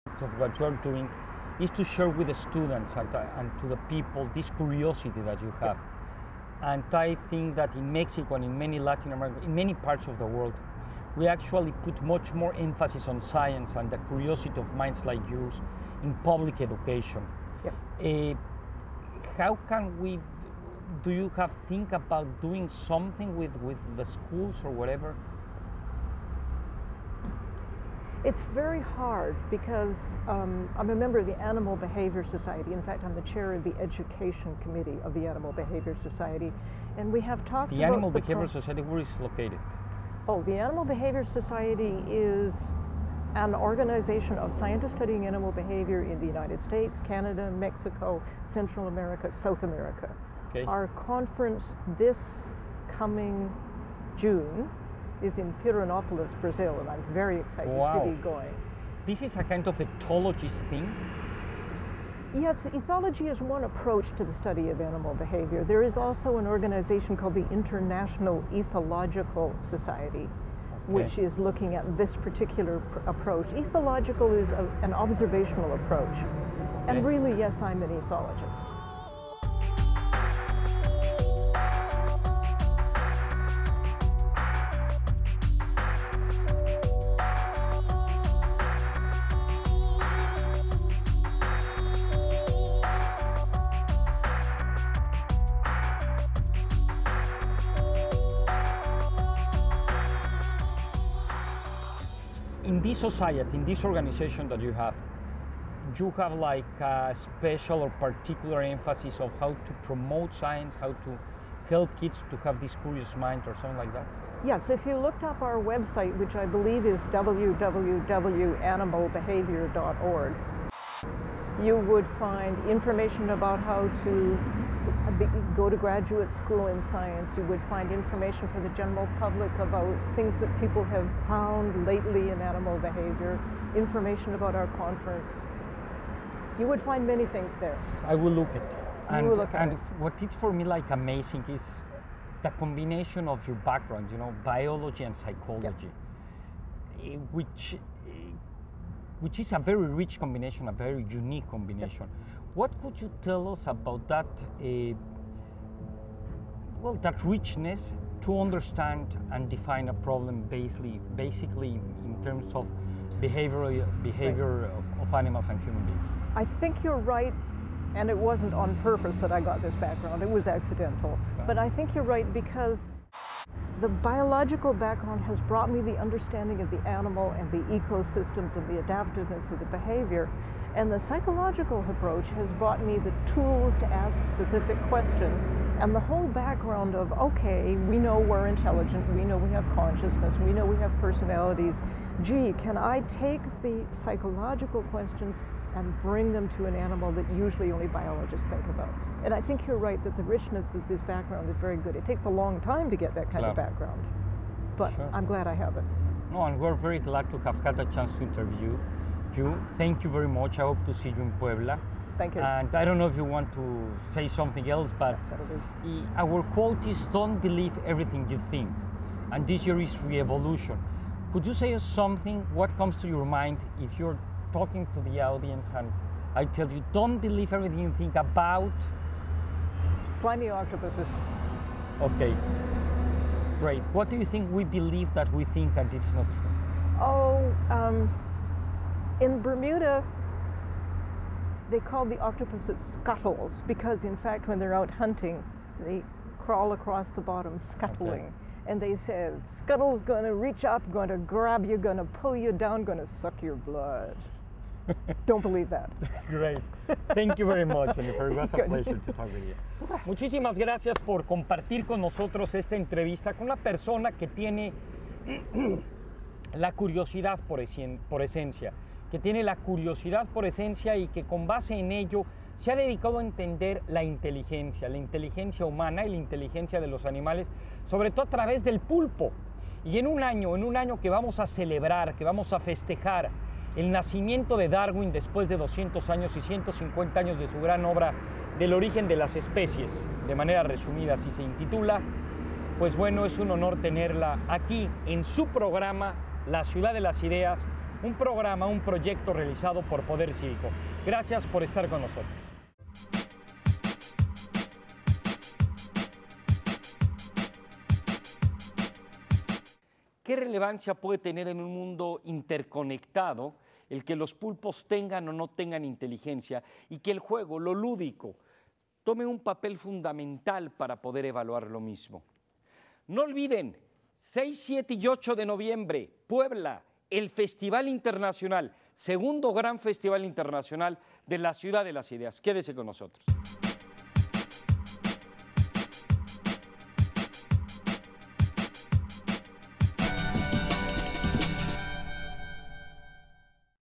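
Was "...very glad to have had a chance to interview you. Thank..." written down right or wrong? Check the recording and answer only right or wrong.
right.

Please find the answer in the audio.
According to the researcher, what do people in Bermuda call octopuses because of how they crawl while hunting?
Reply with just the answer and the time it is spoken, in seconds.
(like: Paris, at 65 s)
scuttles, at 242 s.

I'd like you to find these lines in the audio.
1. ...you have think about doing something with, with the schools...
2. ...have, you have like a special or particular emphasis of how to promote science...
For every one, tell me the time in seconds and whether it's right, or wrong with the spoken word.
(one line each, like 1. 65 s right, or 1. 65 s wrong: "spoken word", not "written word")
1. 21 s right
2. 104 s right.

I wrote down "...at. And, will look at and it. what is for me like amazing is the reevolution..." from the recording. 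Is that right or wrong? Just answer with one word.
wrong.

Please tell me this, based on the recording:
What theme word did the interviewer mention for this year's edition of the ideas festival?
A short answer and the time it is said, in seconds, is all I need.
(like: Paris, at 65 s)
re-evolution, at 220 s.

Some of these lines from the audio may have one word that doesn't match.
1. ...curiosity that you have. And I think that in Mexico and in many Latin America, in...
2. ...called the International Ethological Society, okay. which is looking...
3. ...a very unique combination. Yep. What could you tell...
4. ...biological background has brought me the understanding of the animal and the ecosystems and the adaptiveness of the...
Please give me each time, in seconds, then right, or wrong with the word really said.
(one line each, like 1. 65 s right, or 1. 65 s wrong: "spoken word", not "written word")
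1. 4 s right
2. 67 s right
3. 150 s right
4. 173 s right.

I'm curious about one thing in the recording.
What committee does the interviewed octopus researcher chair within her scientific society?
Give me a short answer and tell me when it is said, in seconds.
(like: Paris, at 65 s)
Education Committee, at 33 s.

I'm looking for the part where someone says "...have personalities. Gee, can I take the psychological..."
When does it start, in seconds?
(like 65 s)
190 s.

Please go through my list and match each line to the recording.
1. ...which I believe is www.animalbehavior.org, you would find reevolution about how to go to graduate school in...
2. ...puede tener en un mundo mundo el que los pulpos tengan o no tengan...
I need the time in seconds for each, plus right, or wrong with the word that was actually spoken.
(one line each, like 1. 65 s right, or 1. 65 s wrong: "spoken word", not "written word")
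1. 116 s wrong: "information", not "reevolution"
2. 310 s wrong: "interconectado", not "mundo".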